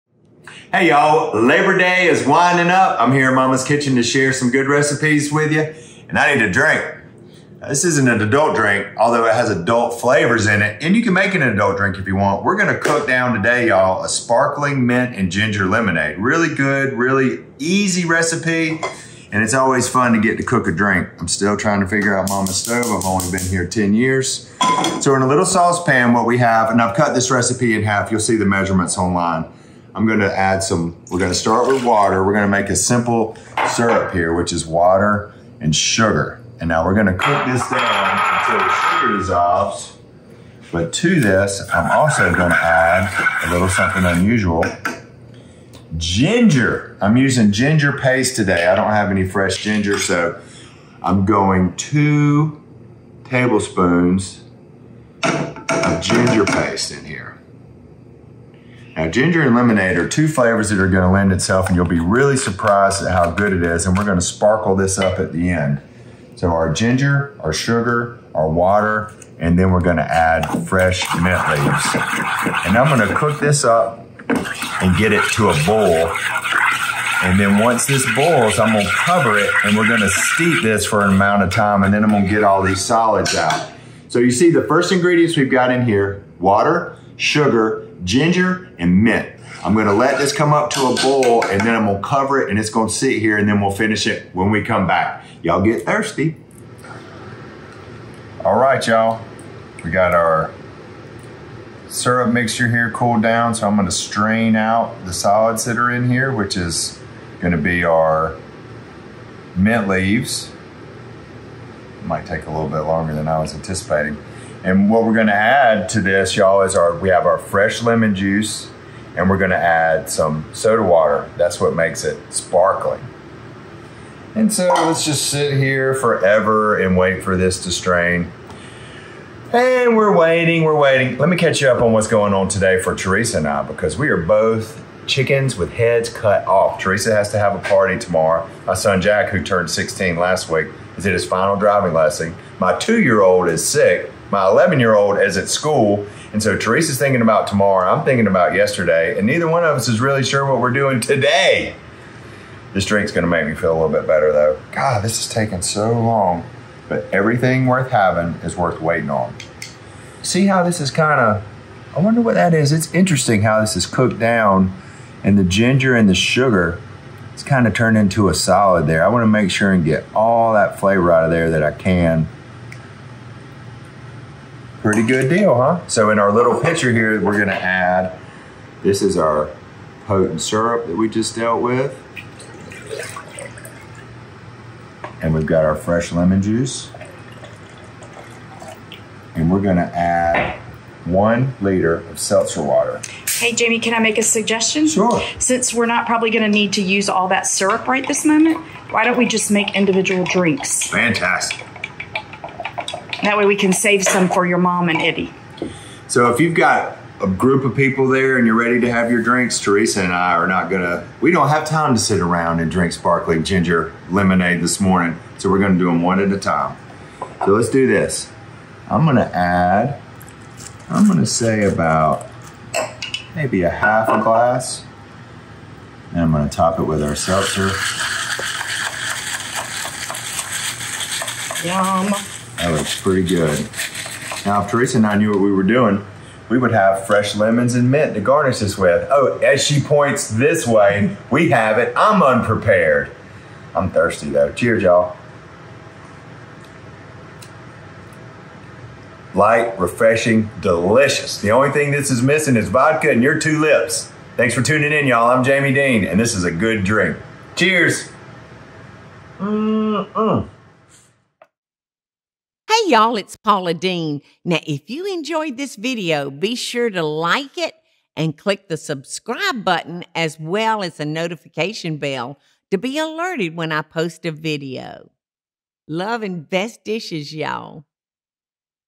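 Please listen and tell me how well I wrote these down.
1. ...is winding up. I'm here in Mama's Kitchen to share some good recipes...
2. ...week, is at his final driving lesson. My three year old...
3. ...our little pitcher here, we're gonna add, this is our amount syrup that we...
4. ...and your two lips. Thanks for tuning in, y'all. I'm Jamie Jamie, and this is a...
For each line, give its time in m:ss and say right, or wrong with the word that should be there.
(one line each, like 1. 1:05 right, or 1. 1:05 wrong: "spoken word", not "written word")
1. 0:02 right
2. 2:20 wrong: "two", not "three"
3. 2:56 wrong: "potent", not "amount"
4. 4:13 wrong: "Deen", not "Jamie".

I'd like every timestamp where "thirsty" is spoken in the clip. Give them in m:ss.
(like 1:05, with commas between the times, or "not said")
1:35, 4:03.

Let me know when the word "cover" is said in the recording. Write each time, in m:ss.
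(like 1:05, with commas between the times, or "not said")
1:18, 1:32.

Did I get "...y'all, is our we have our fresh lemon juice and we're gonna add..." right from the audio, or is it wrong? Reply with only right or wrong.
right.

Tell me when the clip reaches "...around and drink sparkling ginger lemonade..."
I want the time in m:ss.
3:32.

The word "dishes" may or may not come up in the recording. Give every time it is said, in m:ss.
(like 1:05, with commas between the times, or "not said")
4:36.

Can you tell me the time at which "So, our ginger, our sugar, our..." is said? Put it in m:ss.
1:06.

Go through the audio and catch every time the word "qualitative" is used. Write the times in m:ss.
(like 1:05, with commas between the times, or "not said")
not said.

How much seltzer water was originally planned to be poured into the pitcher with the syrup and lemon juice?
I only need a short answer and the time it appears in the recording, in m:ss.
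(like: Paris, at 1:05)
1 liter, at 3:11.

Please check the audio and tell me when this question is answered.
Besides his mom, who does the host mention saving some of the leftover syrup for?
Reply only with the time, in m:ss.
3:24.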